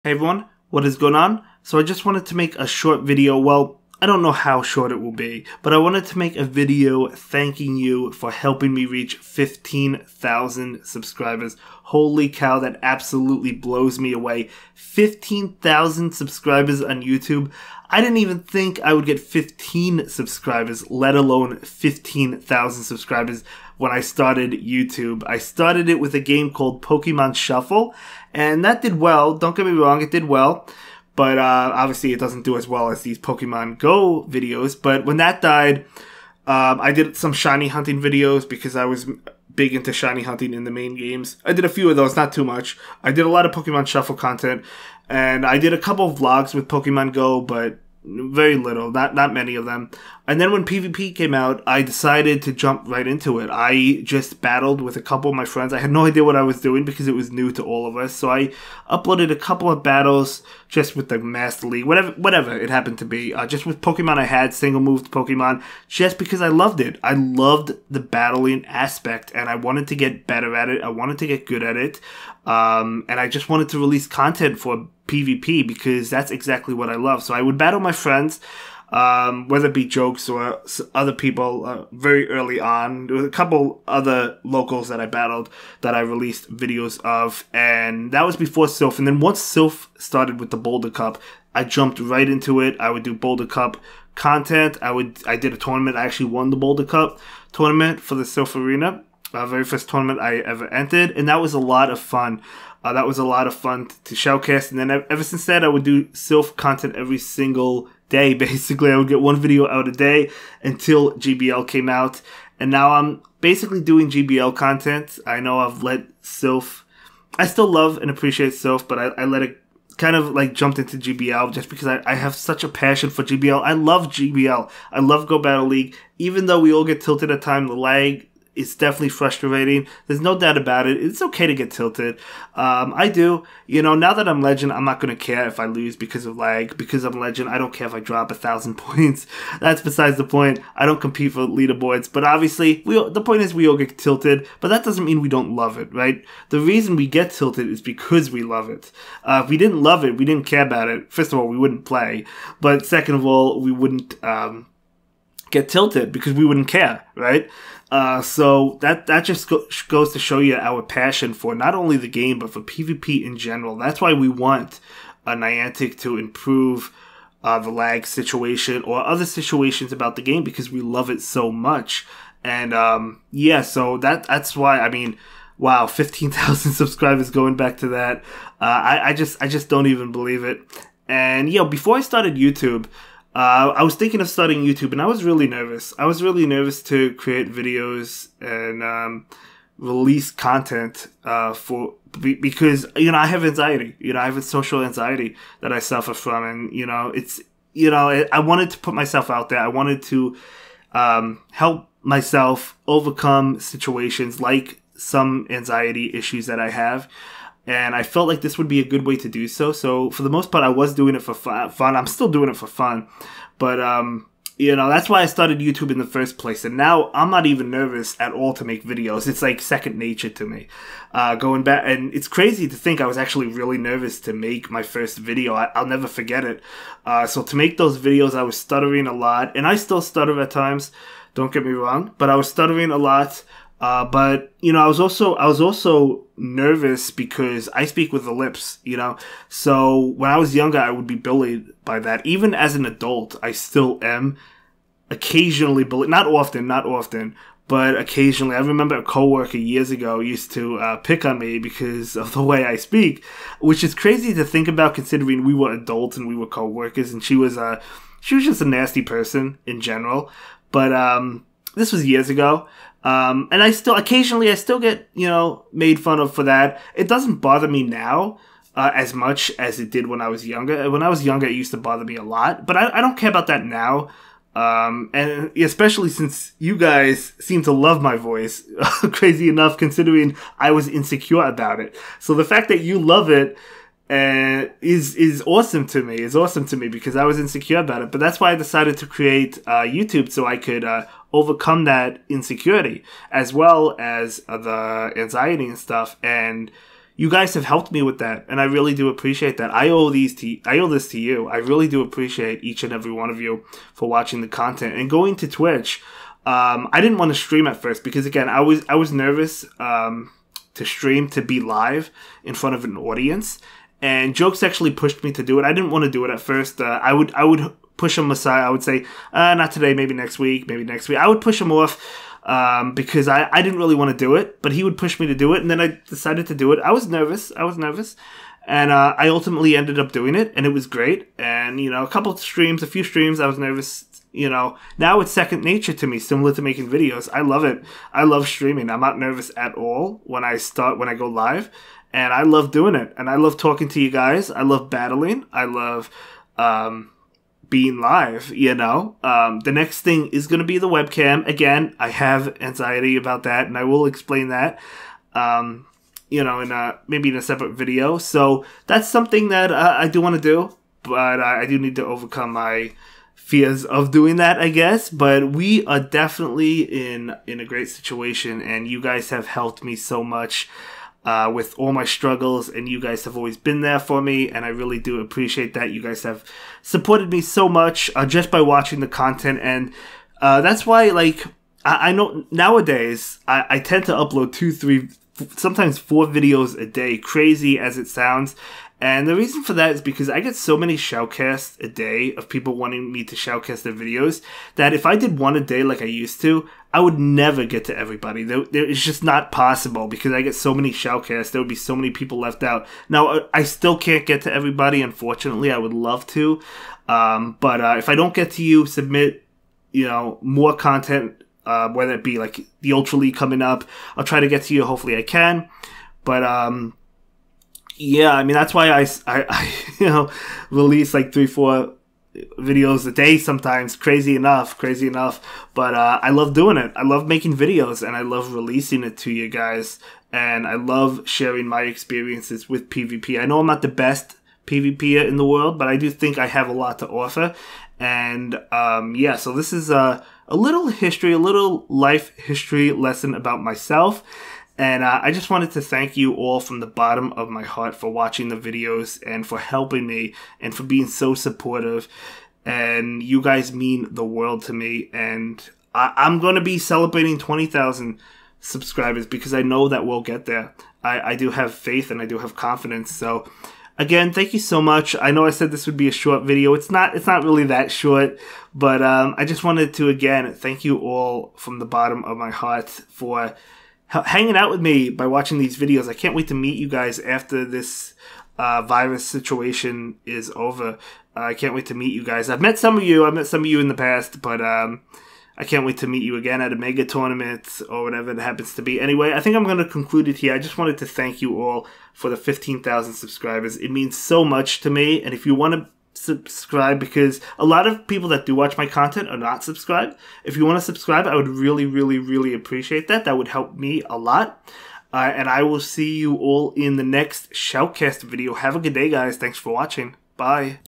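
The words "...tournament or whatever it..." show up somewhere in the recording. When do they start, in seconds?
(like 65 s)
487 s.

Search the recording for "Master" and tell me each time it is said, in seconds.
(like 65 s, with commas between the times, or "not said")
61 s.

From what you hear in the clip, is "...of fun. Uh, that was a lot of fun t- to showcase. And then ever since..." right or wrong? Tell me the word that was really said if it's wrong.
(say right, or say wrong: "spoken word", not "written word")
right.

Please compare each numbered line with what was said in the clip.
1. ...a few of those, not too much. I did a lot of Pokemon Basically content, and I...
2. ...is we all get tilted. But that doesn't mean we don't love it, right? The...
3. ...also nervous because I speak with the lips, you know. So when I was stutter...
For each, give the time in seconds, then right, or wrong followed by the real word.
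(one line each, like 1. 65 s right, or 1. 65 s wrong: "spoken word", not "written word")
1. 41 s wrong: "Shuffle", not "Basically"
2. 143 s right
3. 235 s wrong: "younger", not "stutter".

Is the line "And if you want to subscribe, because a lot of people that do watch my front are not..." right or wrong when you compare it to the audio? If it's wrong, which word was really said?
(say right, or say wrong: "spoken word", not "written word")
wrong: "content", not "front".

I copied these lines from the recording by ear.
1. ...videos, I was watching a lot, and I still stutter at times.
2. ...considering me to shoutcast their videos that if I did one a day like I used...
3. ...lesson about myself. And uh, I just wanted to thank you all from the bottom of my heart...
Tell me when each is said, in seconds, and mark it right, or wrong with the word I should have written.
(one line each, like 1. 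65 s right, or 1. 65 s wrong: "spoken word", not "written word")
1. 227 s wrong: "stuttering", not "watching"
2. 392 s wrong: "wanting", not "considering"
3. 442 s right.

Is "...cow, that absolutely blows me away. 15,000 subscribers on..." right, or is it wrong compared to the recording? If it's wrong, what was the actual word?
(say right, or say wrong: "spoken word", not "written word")
right.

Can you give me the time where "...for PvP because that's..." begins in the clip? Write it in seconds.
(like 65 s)
74 s.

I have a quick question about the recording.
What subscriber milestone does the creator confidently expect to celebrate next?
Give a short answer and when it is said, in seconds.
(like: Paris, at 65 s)
20,000, at 457 s.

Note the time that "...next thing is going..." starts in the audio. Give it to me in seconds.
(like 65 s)
349 s.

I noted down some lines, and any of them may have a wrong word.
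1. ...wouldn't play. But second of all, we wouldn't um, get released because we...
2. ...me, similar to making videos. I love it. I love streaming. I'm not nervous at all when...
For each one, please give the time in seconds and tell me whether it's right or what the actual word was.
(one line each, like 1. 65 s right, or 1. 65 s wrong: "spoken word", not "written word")
1. 151 s wrong: "tilted", not "released"
2. 336 s right.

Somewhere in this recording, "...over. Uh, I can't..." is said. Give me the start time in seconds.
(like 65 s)
480 s.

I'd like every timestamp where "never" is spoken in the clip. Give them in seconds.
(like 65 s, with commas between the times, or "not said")
225 s, 397 s.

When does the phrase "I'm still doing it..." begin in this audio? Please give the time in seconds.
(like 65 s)
211 s.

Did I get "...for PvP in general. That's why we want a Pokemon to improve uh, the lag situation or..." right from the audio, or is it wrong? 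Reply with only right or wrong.
wrong.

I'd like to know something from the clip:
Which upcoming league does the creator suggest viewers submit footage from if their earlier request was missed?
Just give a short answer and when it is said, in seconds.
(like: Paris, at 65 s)
Ultra League, at 412 s.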